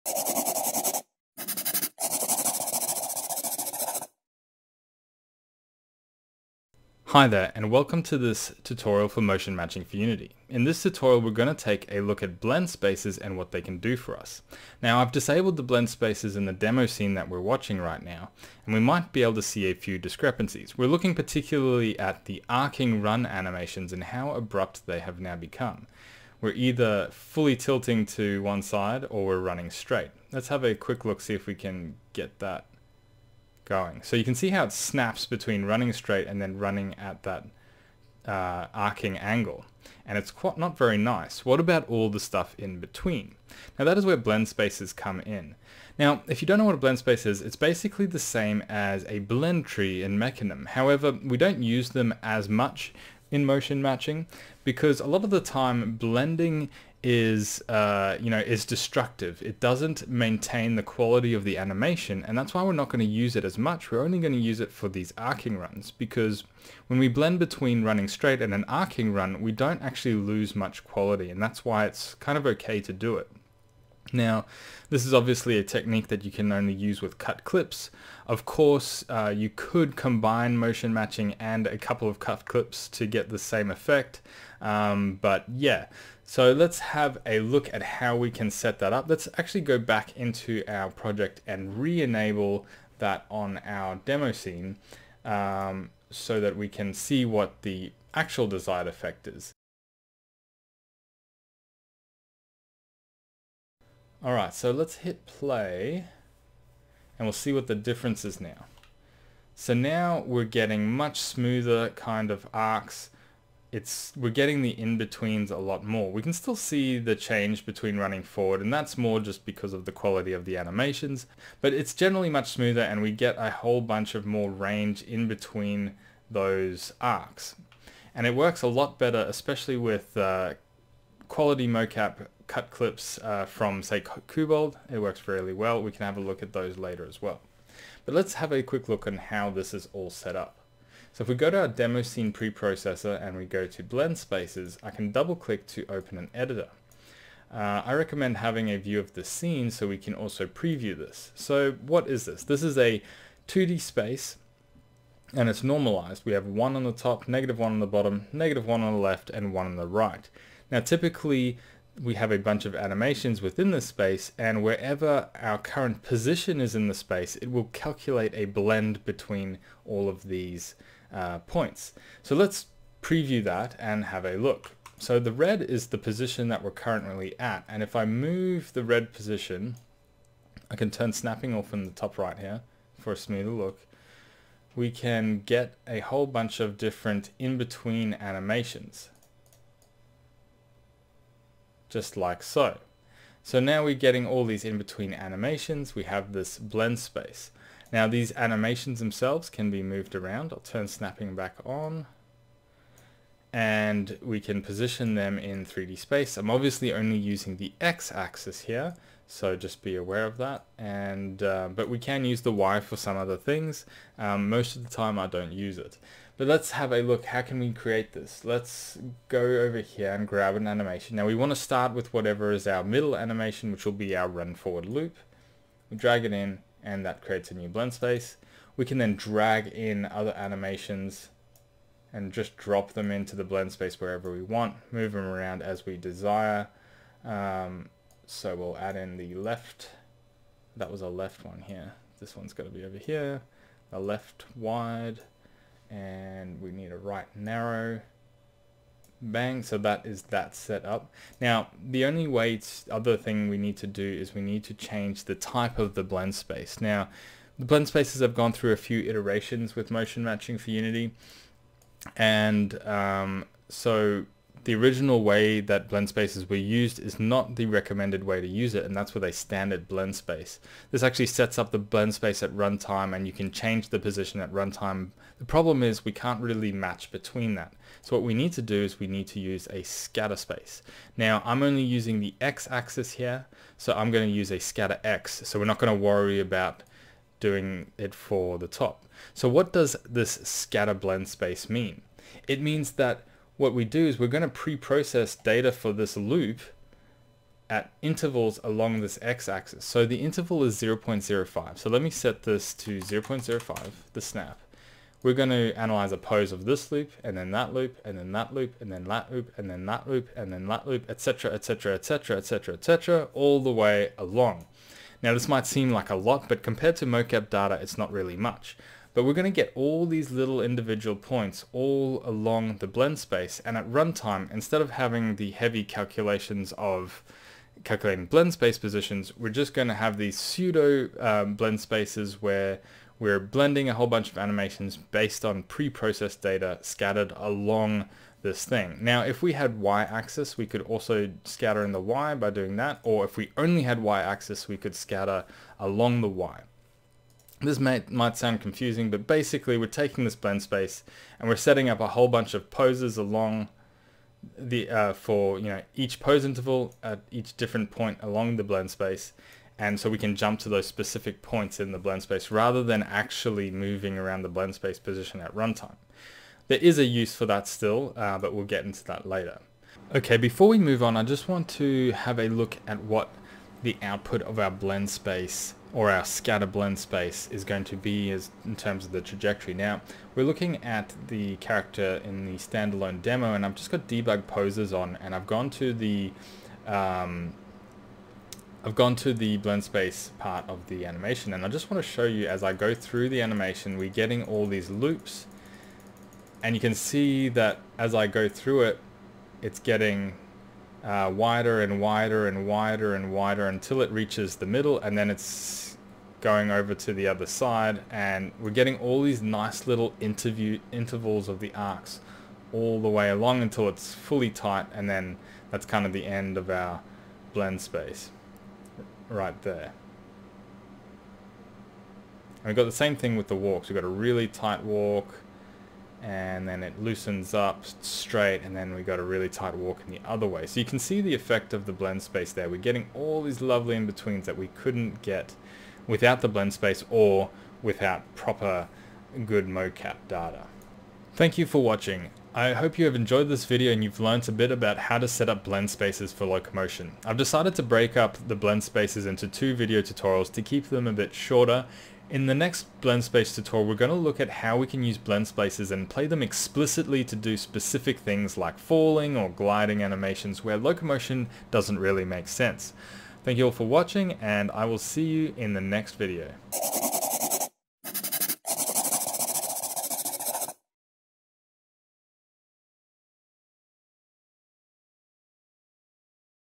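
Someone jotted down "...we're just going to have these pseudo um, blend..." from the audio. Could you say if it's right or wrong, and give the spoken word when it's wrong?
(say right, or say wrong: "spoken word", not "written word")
right.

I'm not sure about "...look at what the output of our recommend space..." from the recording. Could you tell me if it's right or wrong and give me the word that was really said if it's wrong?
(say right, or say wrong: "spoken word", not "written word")
wrong: "blend", not "recommend".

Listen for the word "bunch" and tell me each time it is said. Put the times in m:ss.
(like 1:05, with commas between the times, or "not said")
2:03, 2:42, 3:06, 5:34, 5:52.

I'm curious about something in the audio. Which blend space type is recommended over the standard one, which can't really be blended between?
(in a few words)
Scatter space.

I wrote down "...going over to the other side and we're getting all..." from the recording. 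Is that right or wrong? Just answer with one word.
right.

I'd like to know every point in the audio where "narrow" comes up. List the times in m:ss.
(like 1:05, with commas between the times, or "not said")
4:07.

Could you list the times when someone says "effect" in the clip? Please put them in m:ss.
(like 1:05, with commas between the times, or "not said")
1:23, 1:38, 7:11.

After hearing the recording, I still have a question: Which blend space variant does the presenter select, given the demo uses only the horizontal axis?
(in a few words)
Scatter X.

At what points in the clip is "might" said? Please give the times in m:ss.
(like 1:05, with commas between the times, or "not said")
0:18, 5:15, 5:48.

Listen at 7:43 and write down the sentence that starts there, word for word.
Thank you all for watching and I will see you in the next video.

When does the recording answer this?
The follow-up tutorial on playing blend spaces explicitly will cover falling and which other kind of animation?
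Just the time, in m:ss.
7:39.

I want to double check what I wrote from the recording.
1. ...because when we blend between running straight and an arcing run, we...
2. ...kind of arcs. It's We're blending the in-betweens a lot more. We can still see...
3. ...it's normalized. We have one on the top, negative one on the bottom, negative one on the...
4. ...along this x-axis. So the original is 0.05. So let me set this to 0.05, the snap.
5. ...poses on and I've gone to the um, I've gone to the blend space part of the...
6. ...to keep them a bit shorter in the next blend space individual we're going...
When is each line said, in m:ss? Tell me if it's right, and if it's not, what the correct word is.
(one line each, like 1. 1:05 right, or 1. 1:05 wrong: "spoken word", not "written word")
1. 1:05 right
2. 1:51 wrong: "getting", not "blending"
3. 2:35 right
4. 4:58 wrong: "interval", not "original"
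5. 6:24 right
6. 7:30 wrong: "tutorial", not "individual".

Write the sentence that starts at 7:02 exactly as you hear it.
And we've got the same thing with the walks.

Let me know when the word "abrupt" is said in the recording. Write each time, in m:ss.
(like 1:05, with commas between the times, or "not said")
0:24.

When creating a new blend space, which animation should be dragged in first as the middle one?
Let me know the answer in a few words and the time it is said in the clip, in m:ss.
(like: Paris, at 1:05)
Run forward loop, at 3:44.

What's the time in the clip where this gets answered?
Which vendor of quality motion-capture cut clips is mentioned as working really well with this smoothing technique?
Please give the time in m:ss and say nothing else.
2:14.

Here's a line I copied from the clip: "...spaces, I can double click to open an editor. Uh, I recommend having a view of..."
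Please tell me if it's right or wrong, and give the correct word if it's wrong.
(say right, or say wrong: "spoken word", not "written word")
right.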